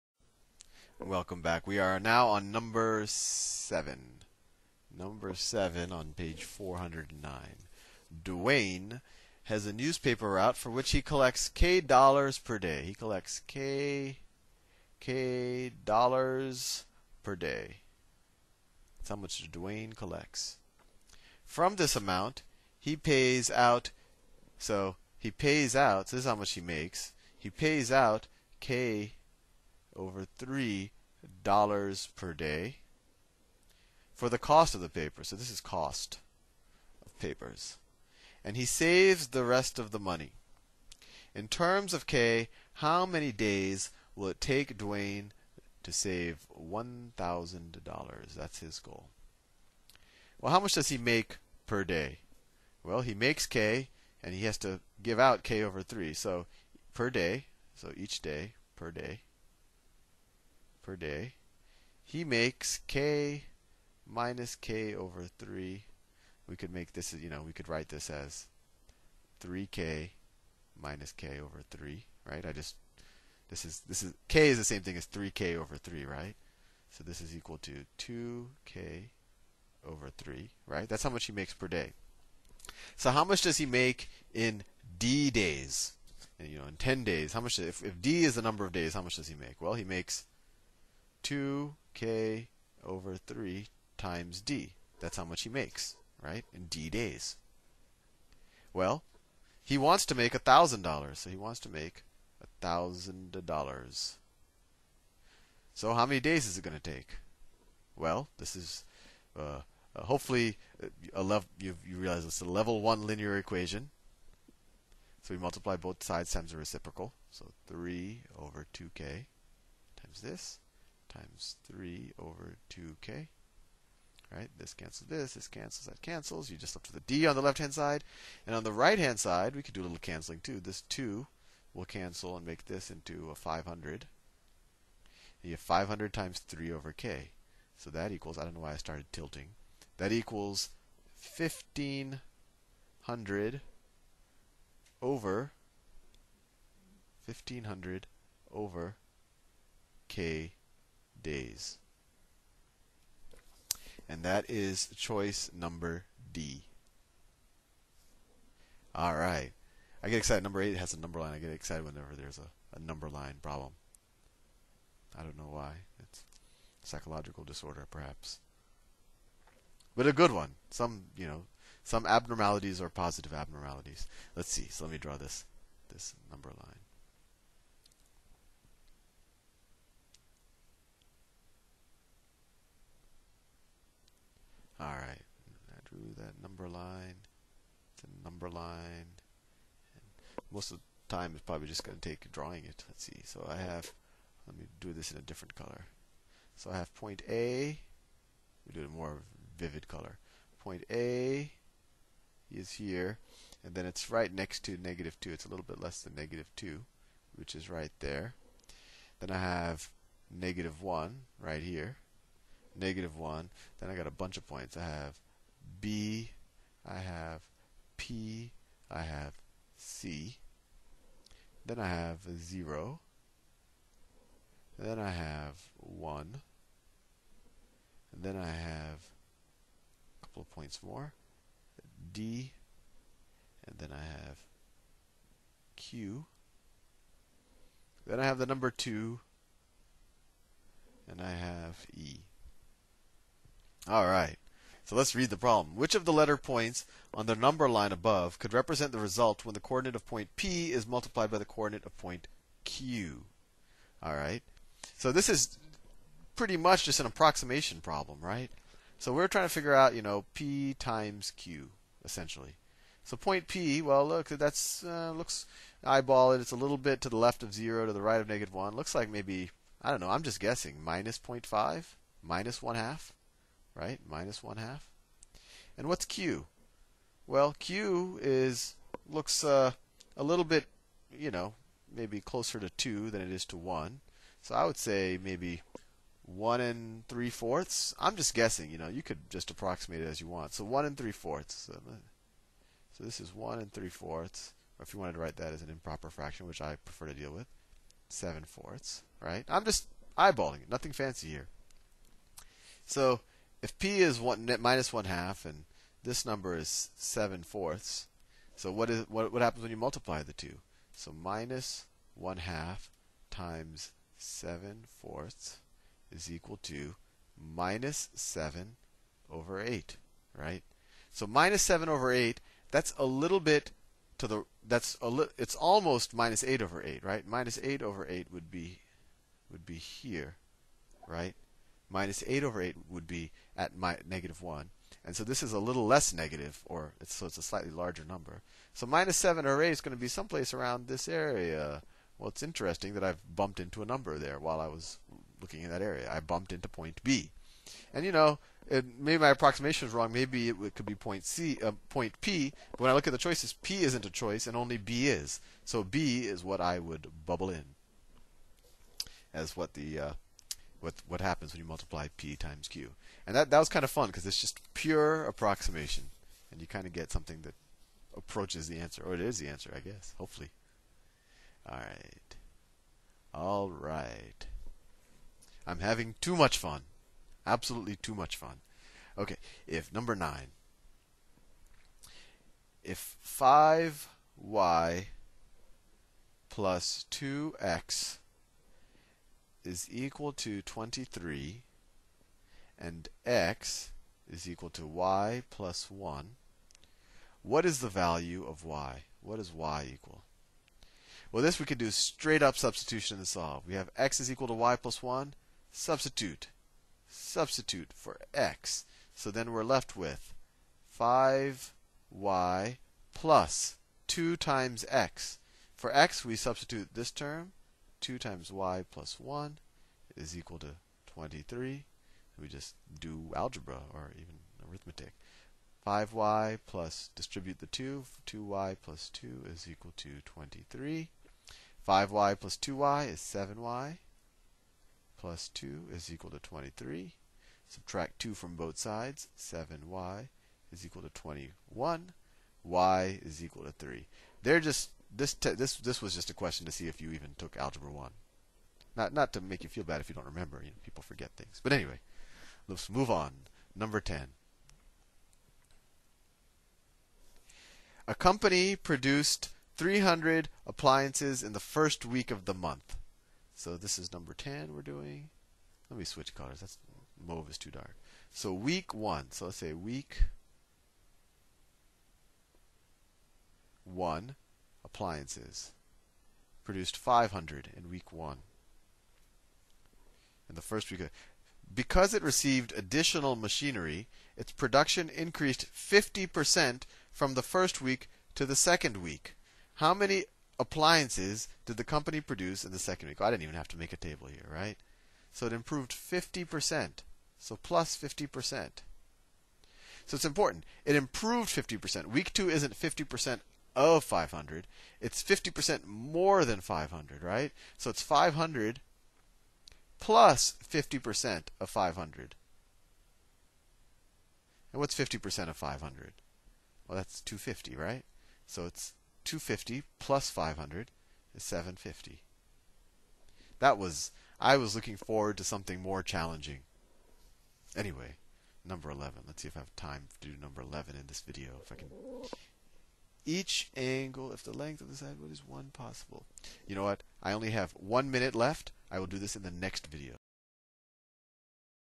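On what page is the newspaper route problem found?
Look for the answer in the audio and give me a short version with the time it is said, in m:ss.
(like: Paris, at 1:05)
409, at 0:06.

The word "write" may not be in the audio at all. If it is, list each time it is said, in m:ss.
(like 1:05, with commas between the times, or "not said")
1:07, 4:55.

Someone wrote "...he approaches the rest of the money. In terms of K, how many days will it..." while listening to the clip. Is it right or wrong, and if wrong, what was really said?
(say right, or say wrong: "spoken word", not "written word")
wrong: "saves", not "approaches".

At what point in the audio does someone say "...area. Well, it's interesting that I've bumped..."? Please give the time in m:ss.
5:41.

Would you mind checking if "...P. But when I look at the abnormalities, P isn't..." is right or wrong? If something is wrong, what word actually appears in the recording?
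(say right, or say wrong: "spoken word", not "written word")
wrong: "choices", not "abnormalities".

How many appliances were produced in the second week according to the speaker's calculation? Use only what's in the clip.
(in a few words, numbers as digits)
750.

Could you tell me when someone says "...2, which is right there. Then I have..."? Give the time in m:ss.
3:26.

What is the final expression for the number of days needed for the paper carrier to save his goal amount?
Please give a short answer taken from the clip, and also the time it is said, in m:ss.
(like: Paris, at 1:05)
1500 over k, at 2:27.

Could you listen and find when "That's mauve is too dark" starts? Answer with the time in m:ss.
7:46.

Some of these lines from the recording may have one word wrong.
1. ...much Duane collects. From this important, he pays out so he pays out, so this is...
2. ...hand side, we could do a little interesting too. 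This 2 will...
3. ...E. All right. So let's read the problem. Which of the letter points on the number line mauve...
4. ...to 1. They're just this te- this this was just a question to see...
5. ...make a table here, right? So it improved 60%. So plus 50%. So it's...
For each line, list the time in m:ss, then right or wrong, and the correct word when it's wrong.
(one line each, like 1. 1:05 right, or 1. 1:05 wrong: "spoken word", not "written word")
1. 0:19 wrong: "amount", not "important"
2. 2:08 wrong: "canceling", not "interesting"
3. 4:01 wrong: "above", not "mauve"
4. 7:23 wrong: "3", not "1"
5. 8:13 wrong: "50", not "60".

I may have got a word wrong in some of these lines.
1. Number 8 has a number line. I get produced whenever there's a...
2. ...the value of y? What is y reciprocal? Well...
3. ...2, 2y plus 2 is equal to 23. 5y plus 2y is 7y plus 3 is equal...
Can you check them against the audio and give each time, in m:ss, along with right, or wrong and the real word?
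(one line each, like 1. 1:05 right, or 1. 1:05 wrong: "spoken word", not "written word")
1. 2:40 wrong: "excited", not "produced"
2. 6:37 wrong: "equal", not "reciprocal"
3. 7:07 wrong: "2", not "3".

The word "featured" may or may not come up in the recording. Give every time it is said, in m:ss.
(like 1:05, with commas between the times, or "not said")
not said.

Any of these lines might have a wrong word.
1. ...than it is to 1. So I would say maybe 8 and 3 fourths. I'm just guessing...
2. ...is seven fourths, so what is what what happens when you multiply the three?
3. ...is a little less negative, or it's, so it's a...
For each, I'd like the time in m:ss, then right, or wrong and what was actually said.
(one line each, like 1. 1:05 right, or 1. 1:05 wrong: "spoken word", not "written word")
1. 4:43 wrong: "1", not "8"
2. 5:06 wrong: "two", not "three"
3. 5:35 right.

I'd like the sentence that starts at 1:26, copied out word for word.
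you know, in 10 days, how much if if d is the number of days, how much does he make?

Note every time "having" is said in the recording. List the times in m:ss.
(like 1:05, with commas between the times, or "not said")
6:15.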